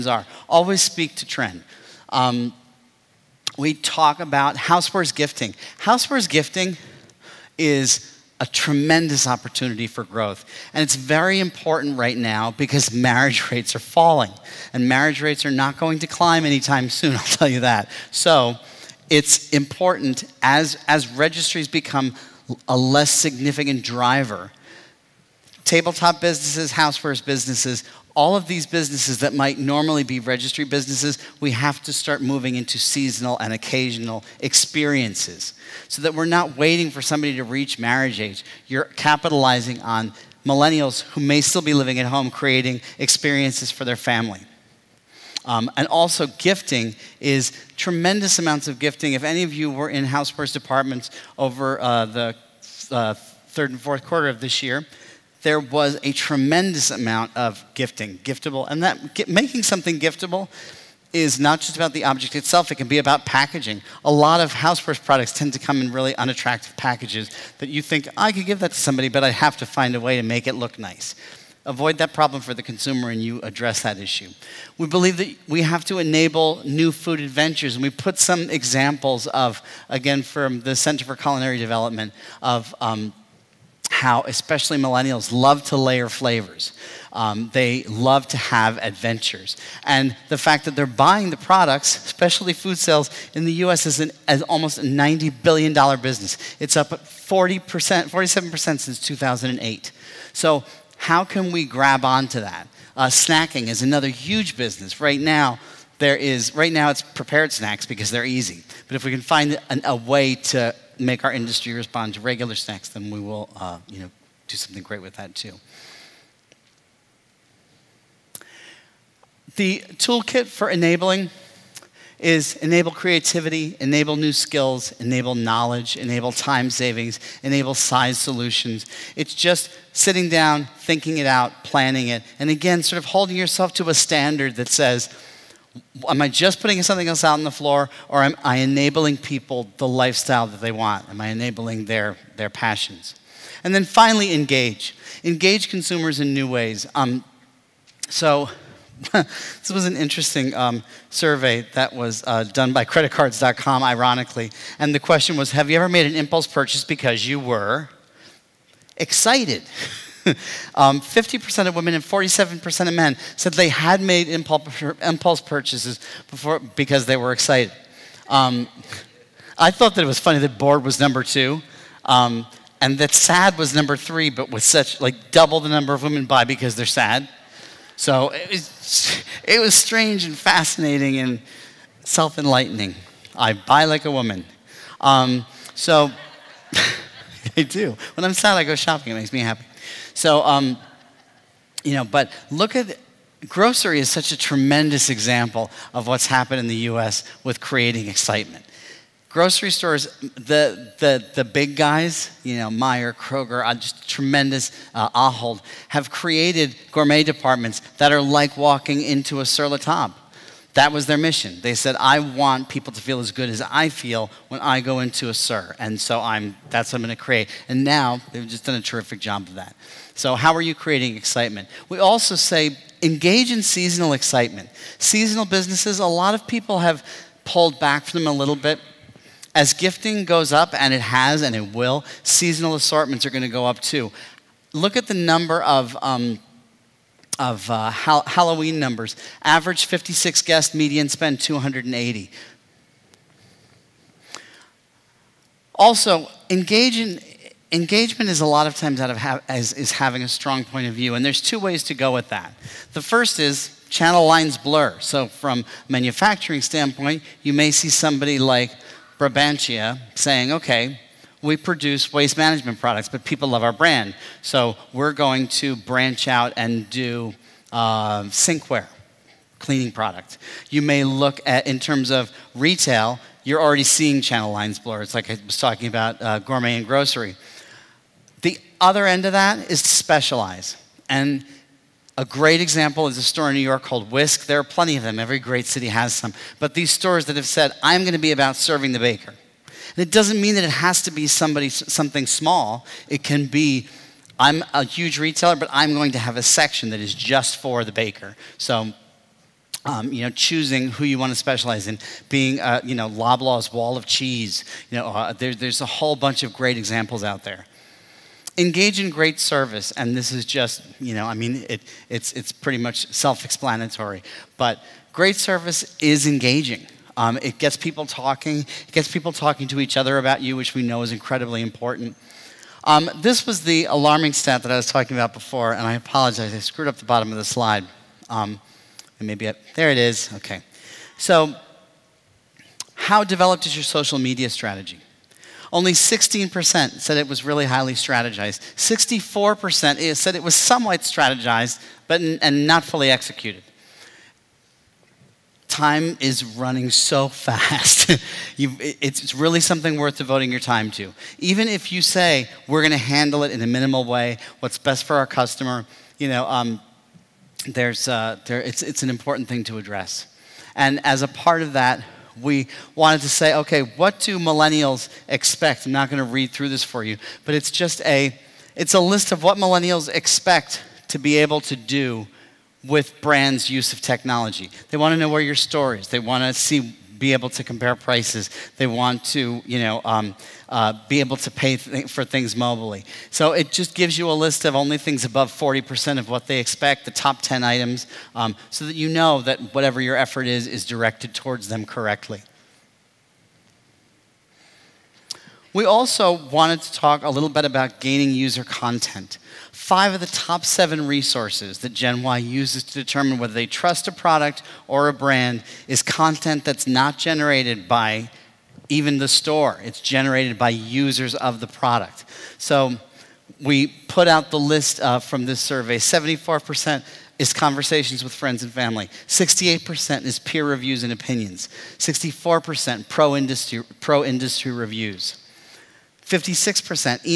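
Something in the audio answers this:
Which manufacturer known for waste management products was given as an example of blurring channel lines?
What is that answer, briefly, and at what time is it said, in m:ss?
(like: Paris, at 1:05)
Brabantia, at 4:19.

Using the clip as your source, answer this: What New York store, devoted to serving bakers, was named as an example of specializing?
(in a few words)
Whisk.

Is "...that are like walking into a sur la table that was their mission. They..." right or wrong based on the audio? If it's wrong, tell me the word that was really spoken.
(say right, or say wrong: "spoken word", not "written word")
right.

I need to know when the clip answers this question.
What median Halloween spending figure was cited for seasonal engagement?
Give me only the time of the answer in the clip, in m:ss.
4:00.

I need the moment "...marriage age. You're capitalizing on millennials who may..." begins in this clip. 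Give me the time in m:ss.
0:37.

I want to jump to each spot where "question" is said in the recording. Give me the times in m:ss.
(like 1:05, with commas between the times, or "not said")
2:35.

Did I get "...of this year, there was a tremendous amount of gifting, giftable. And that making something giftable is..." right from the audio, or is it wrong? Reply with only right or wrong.
right.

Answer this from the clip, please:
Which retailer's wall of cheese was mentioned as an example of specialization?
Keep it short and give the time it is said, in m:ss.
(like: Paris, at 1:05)
Loblaw's, at 5:03.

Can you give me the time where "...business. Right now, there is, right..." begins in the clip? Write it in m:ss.
1:44.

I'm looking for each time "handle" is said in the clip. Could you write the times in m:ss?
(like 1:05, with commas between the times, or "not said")
5:52.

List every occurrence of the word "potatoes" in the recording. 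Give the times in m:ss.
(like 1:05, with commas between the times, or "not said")
not said.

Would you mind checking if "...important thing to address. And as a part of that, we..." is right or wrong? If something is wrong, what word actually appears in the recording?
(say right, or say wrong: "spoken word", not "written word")
right.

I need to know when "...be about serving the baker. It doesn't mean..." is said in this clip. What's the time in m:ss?
4:48.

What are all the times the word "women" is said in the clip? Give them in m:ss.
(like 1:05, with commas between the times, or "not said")
2:41, 2:56.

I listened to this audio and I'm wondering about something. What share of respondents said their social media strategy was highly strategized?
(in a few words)
16%.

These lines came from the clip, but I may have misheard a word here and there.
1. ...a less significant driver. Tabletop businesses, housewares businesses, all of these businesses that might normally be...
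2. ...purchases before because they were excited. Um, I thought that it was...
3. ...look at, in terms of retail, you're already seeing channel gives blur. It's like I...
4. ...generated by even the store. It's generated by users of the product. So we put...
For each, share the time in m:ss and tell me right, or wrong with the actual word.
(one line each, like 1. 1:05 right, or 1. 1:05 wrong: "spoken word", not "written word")
1. 0:22 right
2. 2:45 right
3. 4:31 wrong: "lines", not "gives"
4. 6:47 right.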